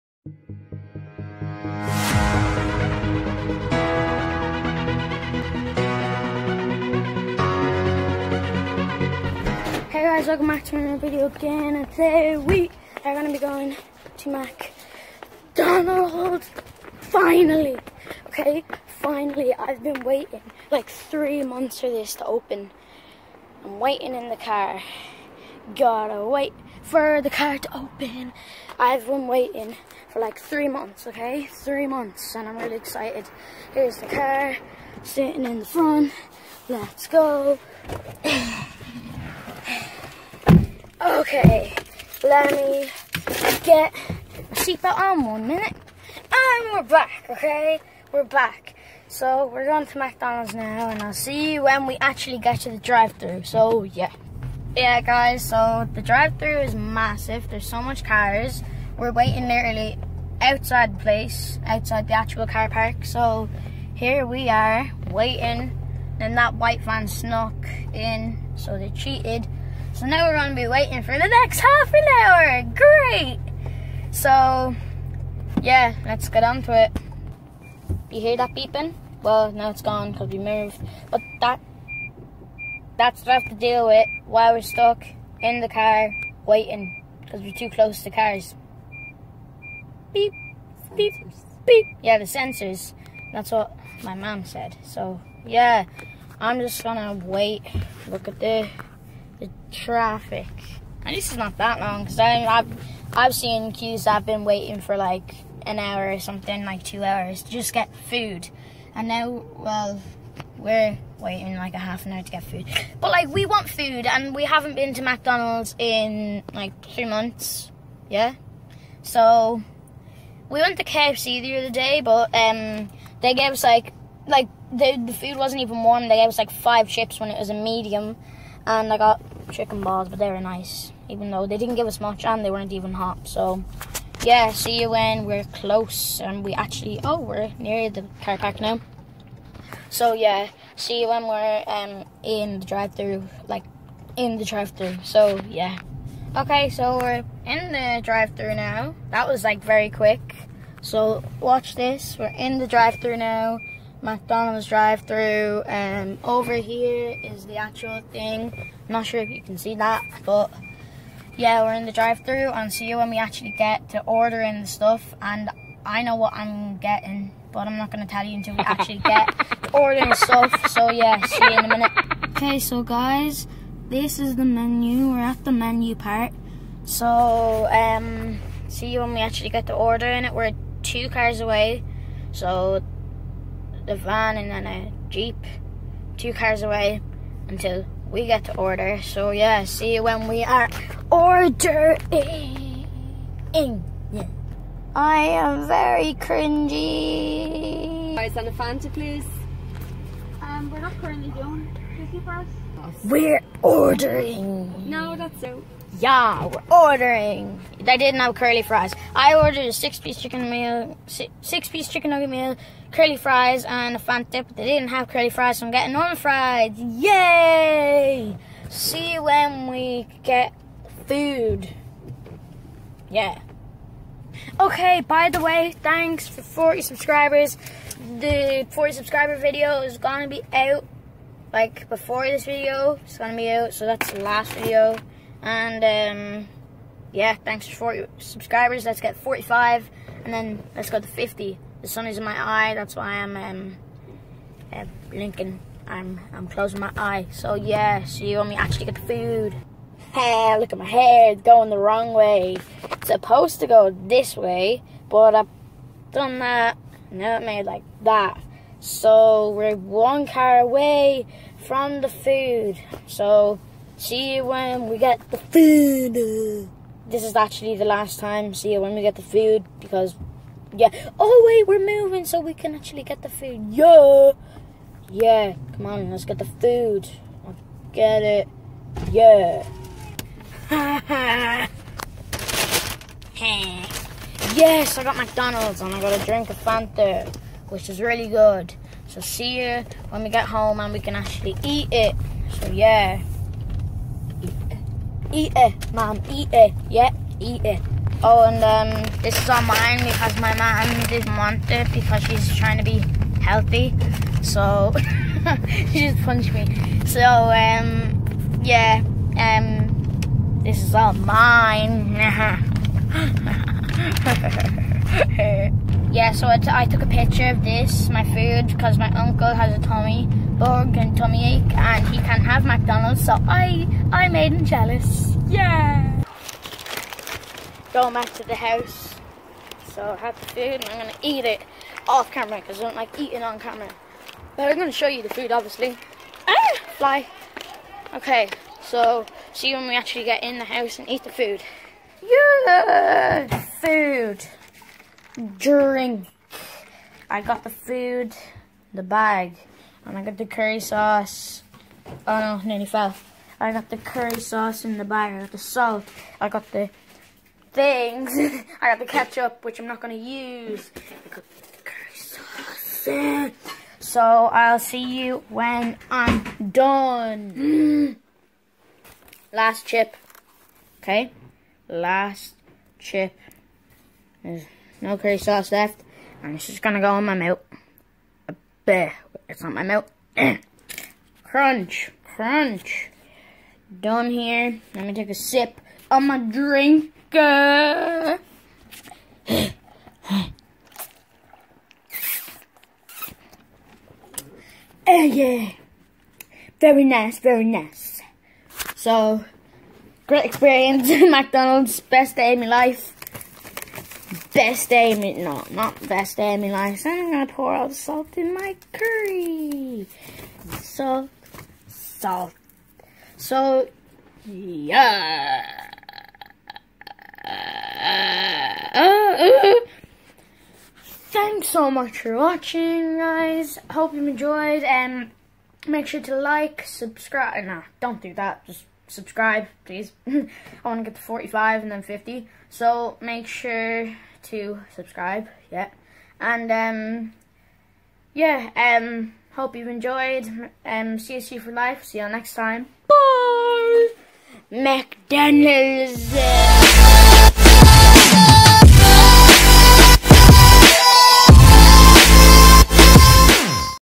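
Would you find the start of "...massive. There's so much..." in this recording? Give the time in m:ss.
0:56.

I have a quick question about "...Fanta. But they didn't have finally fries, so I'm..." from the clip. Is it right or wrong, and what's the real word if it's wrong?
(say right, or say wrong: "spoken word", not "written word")
wrong: "curly", not "finally".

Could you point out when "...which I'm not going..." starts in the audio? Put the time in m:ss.
5:59.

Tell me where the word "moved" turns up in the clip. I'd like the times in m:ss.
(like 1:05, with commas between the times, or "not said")
1:20.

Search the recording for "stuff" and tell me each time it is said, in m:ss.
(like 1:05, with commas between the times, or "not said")
2:44, 2:50.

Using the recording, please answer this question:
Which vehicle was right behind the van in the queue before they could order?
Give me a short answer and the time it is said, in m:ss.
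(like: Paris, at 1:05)
A jeep, at 3:04.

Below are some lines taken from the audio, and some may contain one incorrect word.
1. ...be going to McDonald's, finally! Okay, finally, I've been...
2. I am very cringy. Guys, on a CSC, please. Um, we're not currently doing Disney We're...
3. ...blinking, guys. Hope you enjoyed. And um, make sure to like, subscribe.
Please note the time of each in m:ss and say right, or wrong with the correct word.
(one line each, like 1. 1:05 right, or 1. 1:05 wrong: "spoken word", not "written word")
1. 0:13 right
2. 3:14 wrong: "Fanta", not "CSC"
3. 7:02 wrong: "watching", not "blinking".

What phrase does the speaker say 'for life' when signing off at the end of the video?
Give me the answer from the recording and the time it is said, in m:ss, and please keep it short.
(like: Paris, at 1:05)
CSC, at 7:21.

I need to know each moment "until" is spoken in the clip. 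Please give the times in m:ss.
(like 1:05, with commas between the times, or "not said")
2:48, 3:07.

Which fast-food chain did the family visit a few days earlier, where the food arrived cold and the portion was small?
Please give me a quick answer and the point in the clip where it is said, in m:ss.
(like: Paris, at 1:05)
KFC, at 2:00.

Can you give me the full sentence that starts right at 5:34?
But I'm going to show you the food, obviously.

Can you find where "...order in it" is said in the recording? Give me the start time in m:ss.
2:59.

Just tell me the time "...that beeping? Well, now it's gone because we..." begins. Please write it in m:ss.
1:18.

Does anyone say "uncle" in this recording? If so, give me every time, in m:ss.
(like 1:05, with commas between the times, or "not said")
5:19.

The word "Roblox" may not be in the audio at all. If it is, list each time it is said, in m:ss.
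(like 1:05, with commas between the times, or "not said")
not said.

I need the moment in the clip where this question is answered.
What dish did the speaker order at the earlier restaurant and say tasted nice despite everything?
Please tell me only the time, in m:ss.
2:09.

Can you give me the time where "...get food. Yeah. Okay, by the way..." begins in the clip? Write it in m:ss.
3:40.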